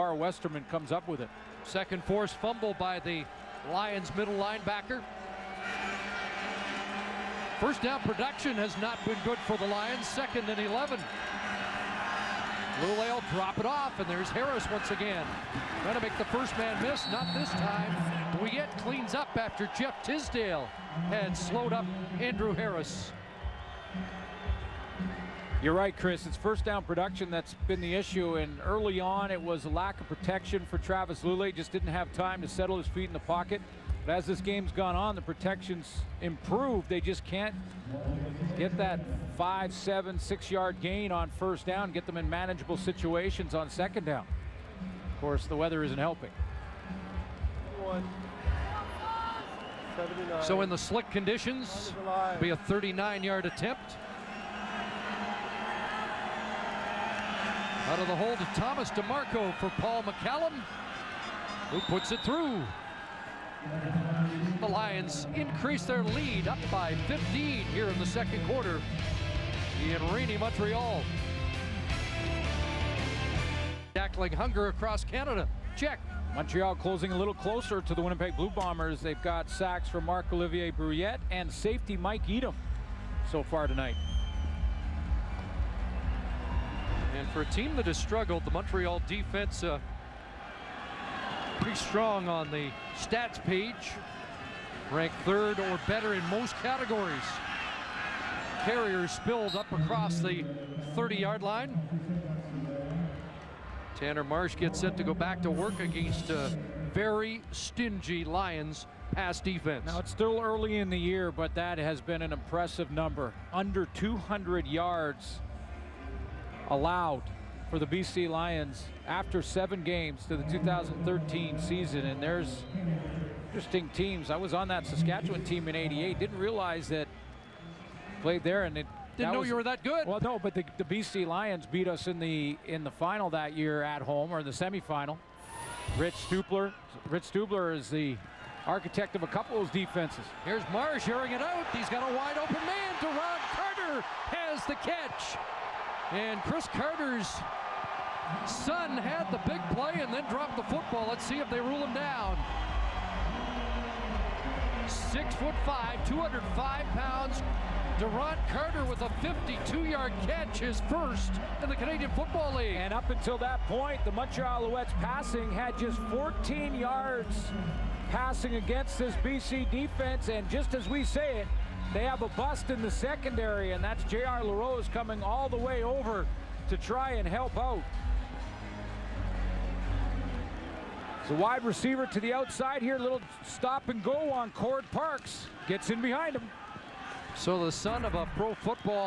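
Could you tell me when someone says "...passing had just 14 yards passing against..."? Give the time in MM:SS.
02:44.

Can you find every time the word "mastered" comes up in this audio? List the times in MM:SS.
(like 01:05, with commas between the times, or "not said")
not said.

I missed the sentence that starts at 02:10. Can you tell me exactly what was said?
Well, no, but the, the, BC Lions beat us in the in the final that year at home or in the semifinal.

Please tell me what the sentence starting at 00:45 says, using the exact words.
Of course, the weather isn't helping.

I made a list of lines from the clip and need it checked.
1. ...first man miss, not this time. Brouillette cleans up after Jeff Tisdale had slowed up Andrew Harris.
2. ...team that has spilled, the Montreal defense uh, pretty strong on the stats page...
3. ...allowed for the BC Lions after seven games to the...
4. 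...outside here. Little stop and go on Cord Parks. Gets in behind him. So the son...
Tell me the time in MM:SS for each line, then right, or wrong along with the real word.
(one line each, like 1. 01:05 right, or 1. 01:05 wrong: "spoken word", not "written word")
1. 00:16 right
2. 01:27 wrong: "struggled", not "spilled"
3. 01:56 right
4. 03:02 right.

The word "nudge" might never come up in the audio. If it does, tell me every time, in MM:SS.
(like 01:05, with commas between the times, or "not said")
not said.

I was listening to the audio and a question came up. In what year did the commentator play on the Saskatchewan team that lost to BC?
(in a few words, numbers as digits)
1988.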